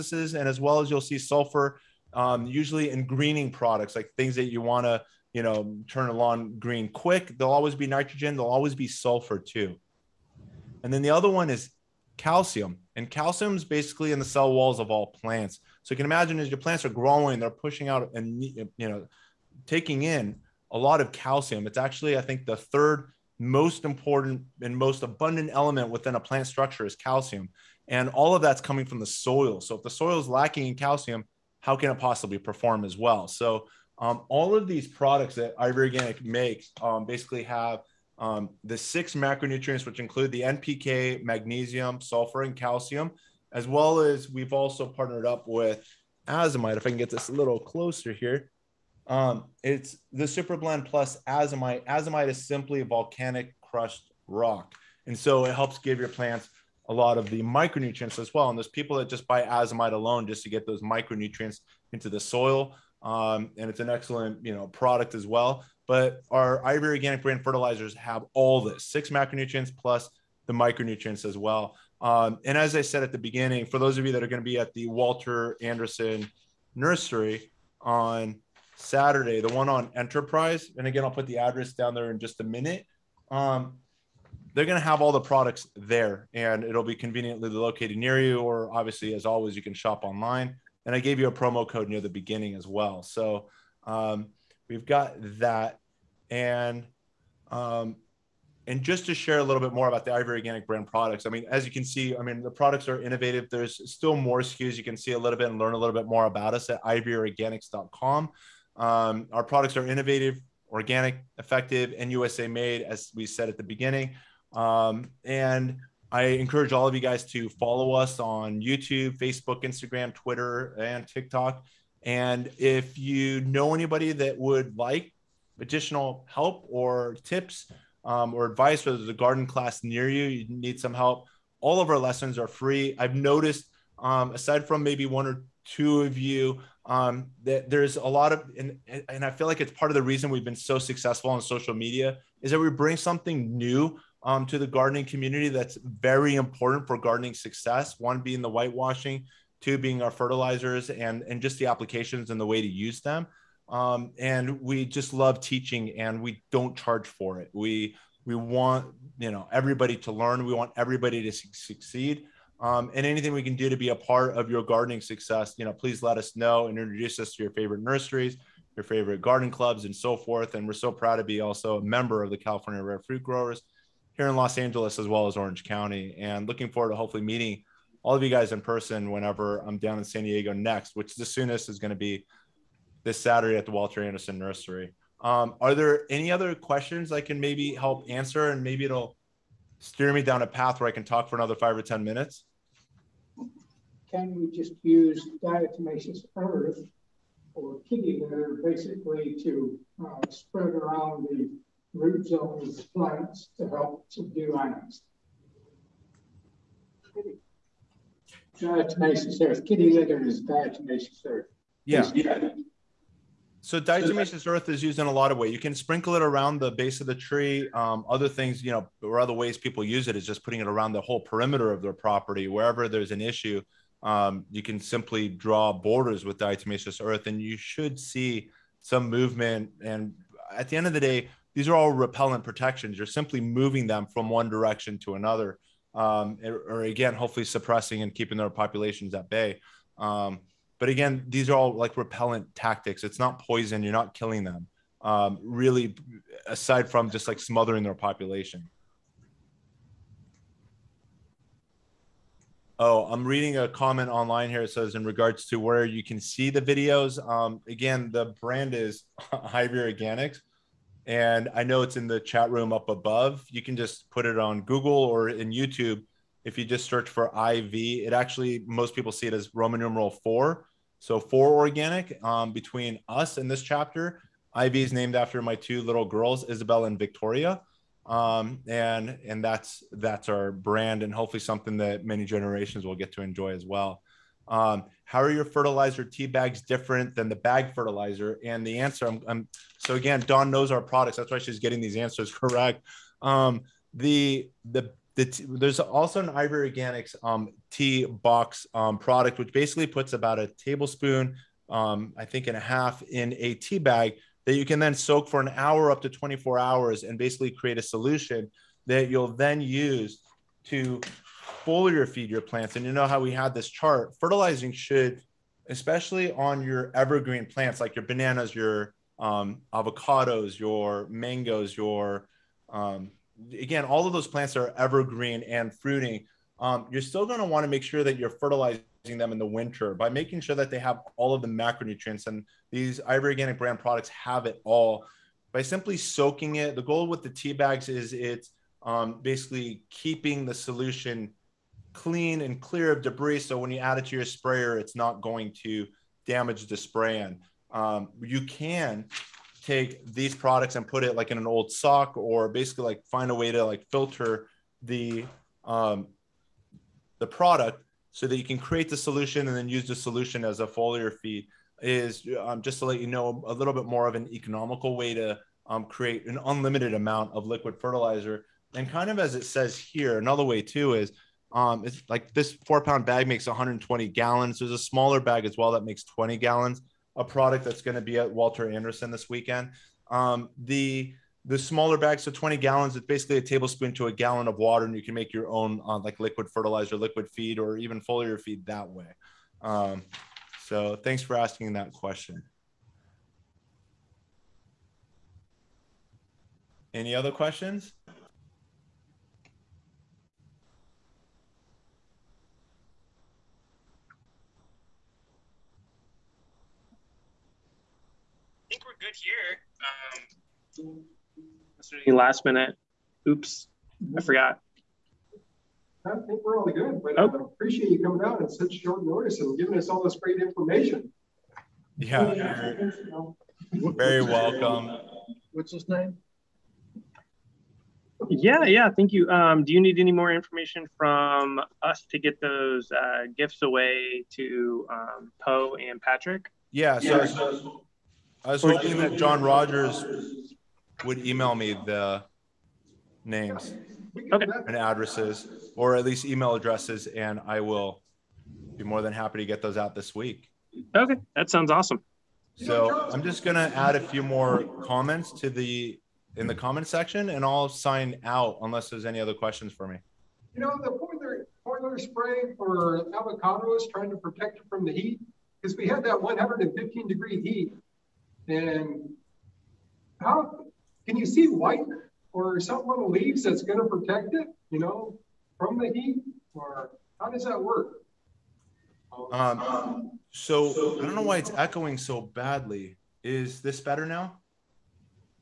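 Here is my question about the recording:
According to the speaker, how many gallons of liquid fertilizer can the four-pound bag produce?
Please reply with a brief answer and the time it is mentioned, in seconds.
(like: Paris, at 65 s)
120 gallons, at 373 s.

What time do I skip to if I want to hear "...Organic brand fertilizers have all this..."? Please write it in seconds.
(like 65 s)
66 s.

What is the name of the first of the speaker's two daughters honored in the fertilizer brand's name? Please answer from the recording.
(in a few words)
Isabel.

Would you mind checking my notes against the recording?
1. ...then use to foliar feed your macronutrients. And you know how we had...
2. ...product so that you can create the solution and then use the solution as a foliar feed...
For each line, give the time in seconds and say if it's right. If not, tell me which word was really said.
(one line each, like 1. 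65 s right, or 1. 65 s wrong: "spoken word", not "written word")
1. 309 s wrong: "plants", not "macronutrients"
2. 357 s right.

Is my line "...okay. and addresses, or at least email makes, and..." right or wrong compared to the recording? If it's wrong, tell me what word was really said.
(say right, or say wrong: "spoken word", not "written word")
wrong: "addresses", not "makes".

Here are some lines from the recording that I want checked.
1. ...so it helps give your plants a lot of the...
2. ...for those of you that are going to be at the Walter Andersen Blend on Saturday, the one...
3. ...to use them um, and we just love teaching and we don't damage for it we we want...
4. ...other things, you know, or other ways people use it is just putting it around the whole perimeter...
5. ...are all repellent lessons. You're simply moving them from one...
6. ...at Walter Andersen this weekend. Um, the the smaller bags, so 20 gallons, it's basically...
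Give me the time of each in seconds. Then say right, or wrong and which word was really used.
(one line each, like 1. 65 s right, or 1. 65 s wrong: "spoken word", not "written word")
1. 55 s right
2. 73 s wrong: "Nursery", not "Blend"
3. 152 s wrong: "charge", not "damage"
4. 218 s right
5. 231 s wrong: "protections", not "lessons"
6. 378 s right.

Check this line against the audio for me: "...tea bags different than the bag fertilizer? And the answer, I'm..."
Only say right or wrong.
right.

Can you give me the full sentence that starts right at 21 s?
It's actually, I think, the third most important and most abundant element within a plant structure is calcium.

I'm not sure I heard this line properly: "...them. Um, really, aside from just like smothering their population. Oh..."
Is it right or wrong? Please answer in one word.
right.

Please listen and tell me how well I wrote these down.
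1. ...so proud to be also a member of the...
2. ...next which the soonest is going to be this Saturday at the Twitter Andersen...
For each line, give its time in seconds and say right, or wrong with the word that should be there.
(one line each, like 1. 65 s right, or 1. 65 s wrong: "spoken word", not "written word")
1. 170 s right
2. 180 s wrong: "Walter", not "Twitter".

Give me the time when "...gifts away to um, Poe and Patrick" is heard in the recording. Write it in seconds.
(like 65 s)
433 s.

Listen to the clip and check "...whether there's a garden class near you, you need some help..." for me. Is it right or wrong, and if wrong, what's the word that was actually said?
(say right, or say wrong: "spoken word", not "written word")
right.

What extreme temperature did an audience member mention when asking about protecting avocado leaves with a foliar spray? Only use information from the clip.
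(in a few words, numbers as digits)
115 degrees.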